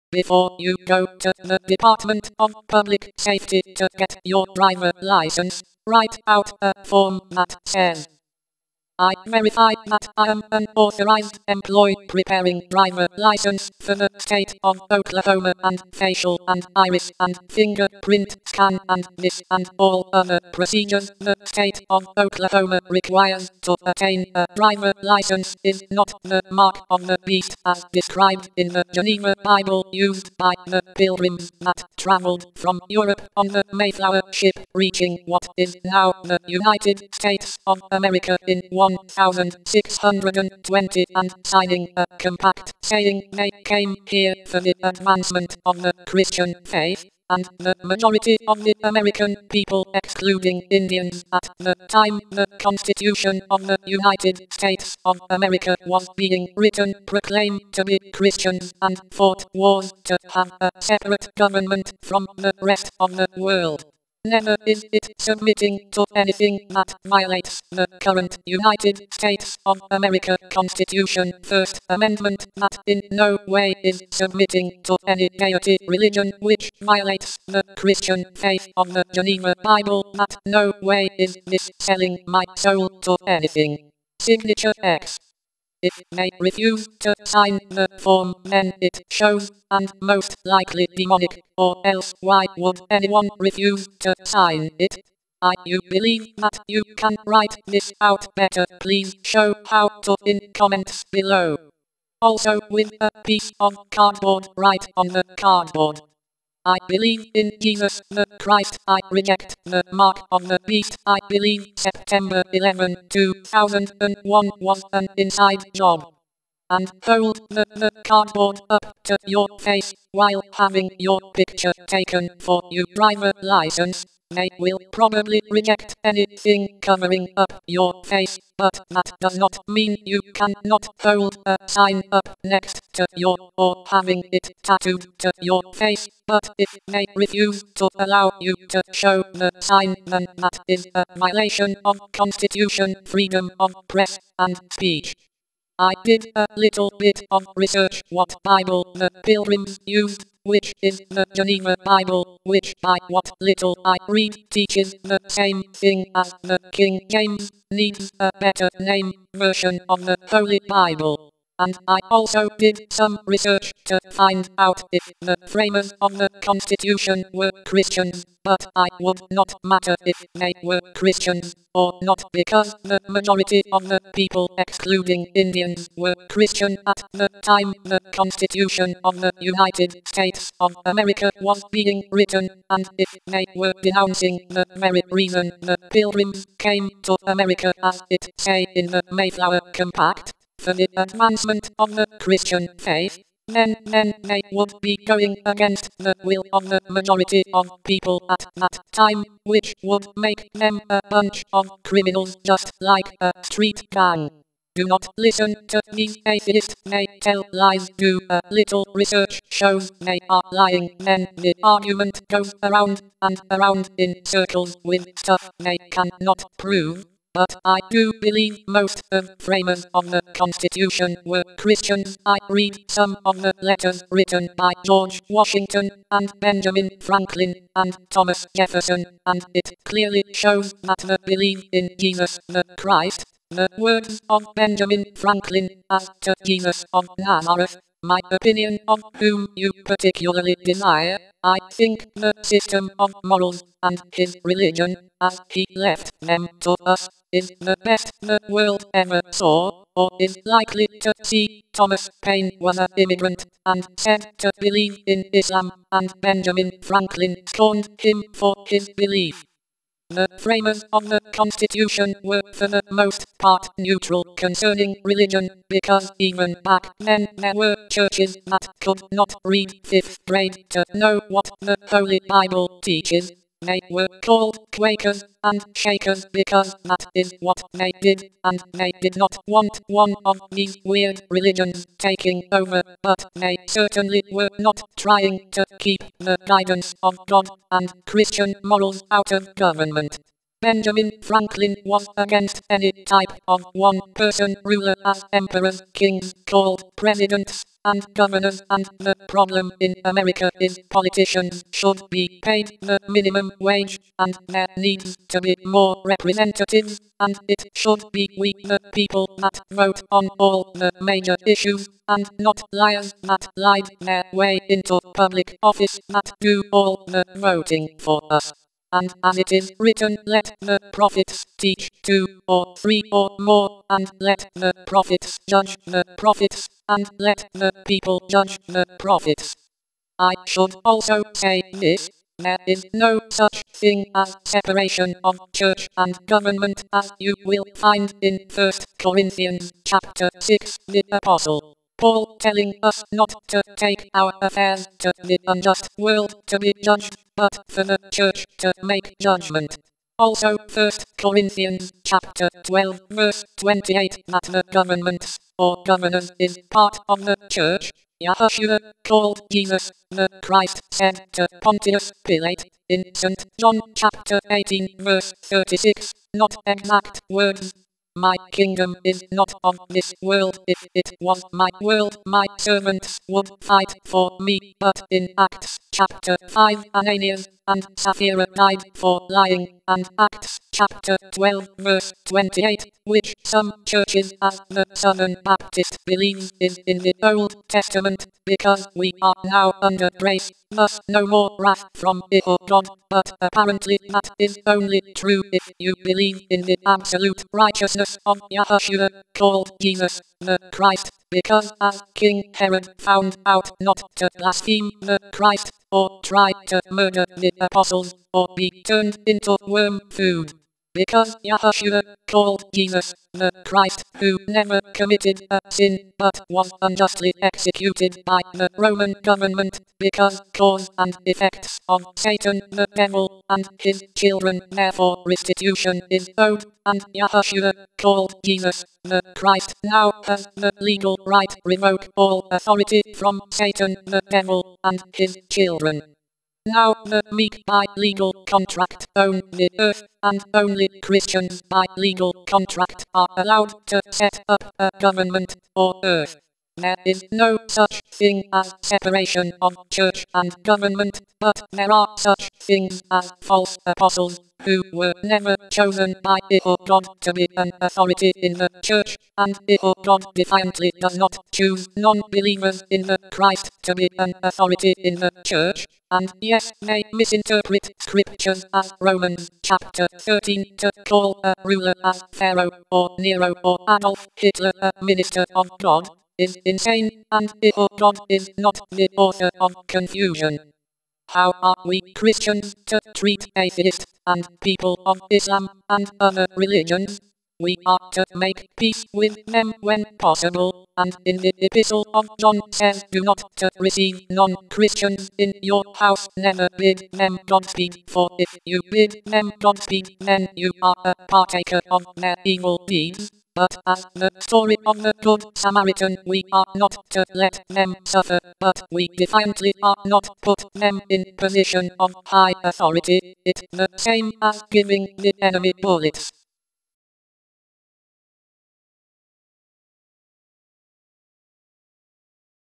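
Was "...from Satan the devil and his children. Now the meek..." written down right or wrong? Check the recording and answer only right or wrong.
right.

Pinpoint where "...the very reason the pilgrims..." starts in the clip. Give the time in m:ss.
3:04.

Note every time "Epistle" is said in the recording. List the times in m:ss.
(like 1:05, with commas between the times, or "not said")
8:11.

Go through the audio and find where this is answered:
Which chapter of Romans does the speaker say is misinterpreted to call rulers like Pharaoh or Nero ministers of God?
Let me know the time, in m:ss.
7:49.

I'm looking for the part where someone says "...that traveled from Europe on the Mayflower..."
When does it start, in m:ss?
0:31.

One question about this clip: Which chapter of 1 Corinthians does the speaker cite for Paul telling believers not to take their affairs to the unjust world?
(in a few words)
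Chapter 6.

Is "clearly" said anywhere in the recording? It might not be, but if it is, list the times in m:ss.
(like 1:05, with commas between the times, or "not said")
3:49.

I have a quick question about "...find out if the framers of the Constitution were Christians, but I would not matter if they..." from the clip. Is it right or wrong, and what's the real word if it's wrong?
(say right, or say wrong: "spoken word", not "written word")
right.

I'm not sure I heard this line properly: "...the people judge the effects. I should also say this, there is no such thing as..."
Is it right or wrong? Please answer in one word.
wrong.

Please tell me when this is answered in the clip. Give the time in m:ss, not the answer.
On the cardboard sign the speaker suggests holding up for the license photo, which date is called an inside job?
1:51.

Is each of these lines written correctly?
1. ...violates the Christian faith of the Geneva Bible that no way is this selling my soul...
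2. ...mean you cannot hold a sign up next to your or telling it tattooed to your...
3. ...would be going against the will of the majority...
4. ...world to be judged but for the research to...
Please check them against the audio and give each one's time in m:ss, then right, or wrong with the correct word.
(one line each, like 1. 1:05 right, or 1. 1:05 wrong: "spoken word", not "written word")
1. 1:16 right
2. 2:09 wrong: "having", not "telling"
3. 3:14 right
4. 5:45 wrong: "church", not "research".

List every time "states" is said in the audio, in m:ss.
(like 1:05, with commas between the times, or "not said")
0:14, 0:21, 0:37, 0:54, 1:09, 3:00.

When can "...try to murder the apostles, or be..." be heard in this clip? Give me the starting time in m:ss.
6:46.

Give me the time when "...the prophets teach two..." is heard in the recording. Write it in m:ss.
5:20.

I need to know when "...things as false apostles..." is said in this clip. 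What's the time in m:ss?
7:32.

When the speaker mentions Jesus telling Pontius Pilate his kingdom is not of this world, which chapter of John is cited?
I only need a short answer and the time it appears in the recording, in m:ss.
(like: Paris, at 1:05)
Chapter 18, at 6:03.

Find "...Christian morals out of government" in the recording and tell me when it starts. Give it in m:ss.
4:48.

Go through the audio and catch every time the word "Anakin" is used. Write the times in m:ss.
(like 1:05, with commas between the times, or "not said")
not said.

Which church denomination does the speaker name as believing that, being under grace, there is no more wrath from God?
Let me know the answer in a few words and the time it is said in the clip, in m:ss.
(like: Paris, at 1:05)
Southern Baptist, at 6:24.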